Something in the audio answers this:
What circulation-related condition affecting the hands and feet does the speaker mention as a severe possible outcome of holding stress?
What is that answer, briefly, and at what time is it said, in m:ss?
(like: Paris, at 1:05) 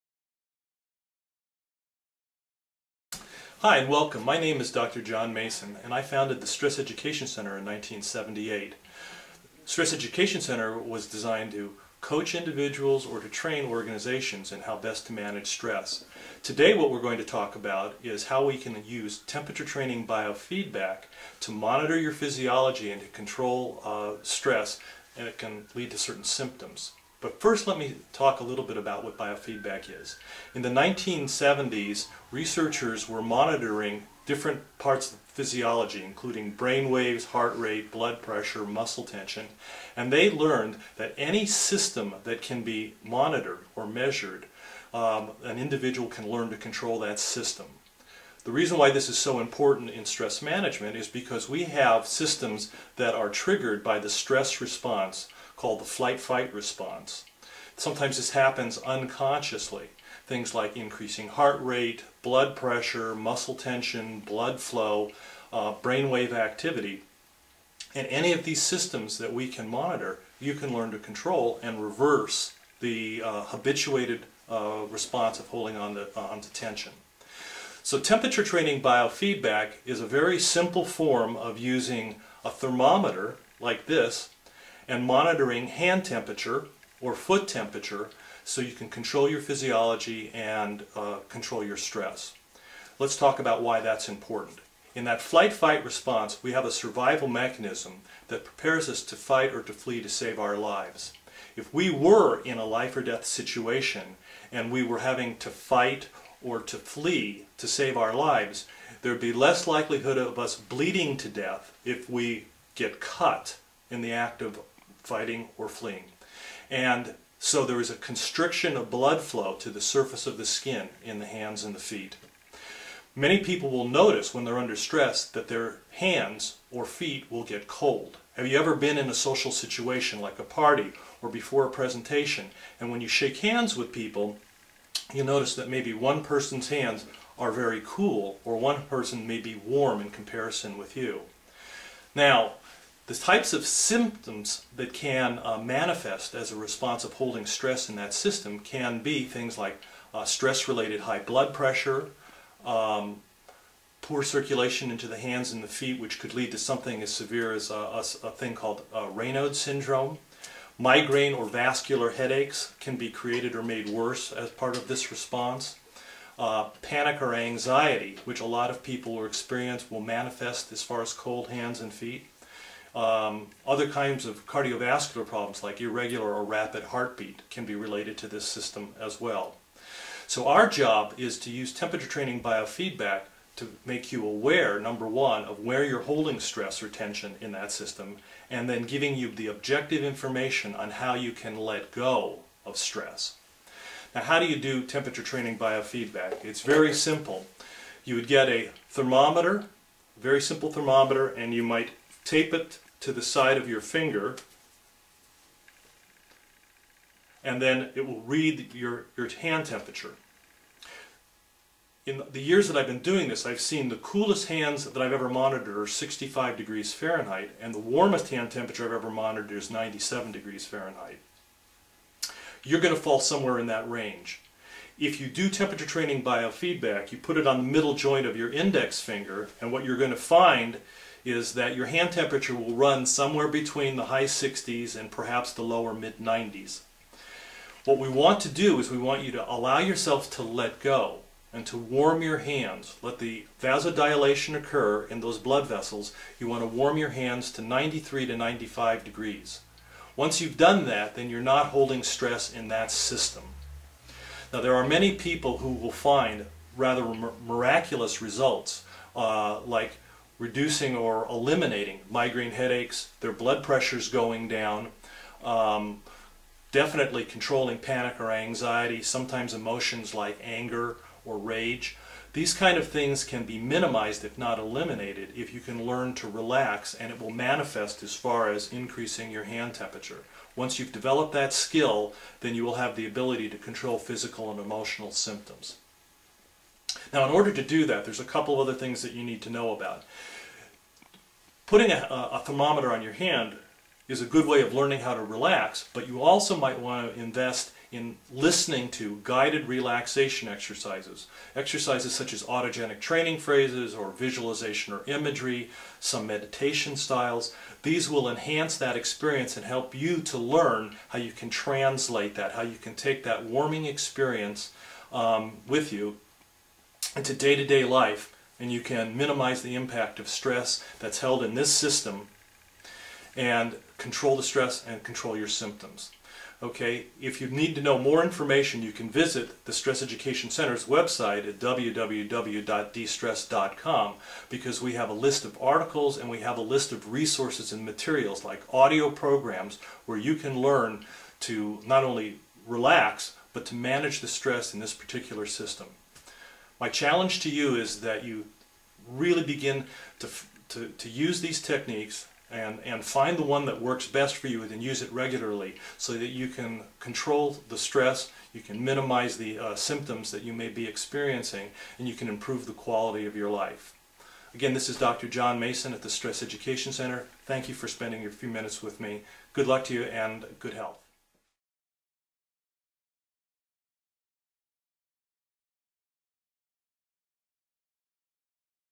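Raynaud's syndrome, at 2:39.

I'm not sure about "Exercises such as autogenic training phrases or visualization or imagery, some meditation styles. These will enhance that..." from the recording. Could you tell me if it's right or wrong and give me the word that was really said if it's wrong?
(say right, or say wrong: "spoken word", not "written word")
right.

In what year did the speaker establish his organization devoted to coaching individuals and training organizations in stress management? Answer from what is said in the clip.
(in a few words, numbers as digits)
1978.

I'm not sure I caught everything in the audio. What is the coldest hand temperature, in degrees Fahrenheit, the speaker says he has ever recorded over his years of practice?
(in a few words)
65.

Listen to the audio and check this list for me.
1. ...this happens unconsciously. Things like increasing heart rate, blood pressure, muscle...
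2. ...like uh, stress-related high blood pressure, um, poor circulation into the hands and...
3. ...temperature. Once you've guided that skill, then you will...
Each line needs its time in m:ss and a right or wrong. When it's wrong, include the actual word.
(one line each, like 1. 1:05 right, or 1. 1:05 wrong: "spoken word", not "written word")
1. 0:58 right
2. 2:29 right
3. 4:39 wrong: "developed", not "guided".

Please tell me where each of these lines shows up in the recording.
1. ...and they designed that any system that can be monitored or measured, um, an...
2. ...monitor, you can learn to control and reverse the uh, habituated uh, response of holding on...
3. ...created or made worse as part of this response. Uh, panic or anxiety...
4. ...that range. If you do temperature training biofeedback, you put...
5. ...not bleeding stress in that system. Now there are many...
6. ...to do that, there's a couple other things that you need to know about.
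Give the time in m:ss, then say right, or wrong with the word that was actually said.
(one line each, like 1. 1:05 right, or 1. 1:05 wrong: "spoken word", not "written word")
1. 0:39 wrong: "learned", not "designed"
2. 1:09 right
3. 2:43 right
4. 3:43 right
5. 4:11 wrong: "holding", not "bleeding"
6. 4:47 right.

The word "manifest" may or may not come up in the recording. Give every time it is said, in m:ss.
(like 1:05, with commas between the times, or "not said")
2:25, 2:50, 4:37.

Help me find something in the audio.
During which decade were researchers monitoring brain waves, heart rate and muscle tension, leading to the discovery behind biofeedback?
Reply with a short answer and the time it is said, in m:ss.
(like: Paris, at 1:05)
1970s, at 0:30.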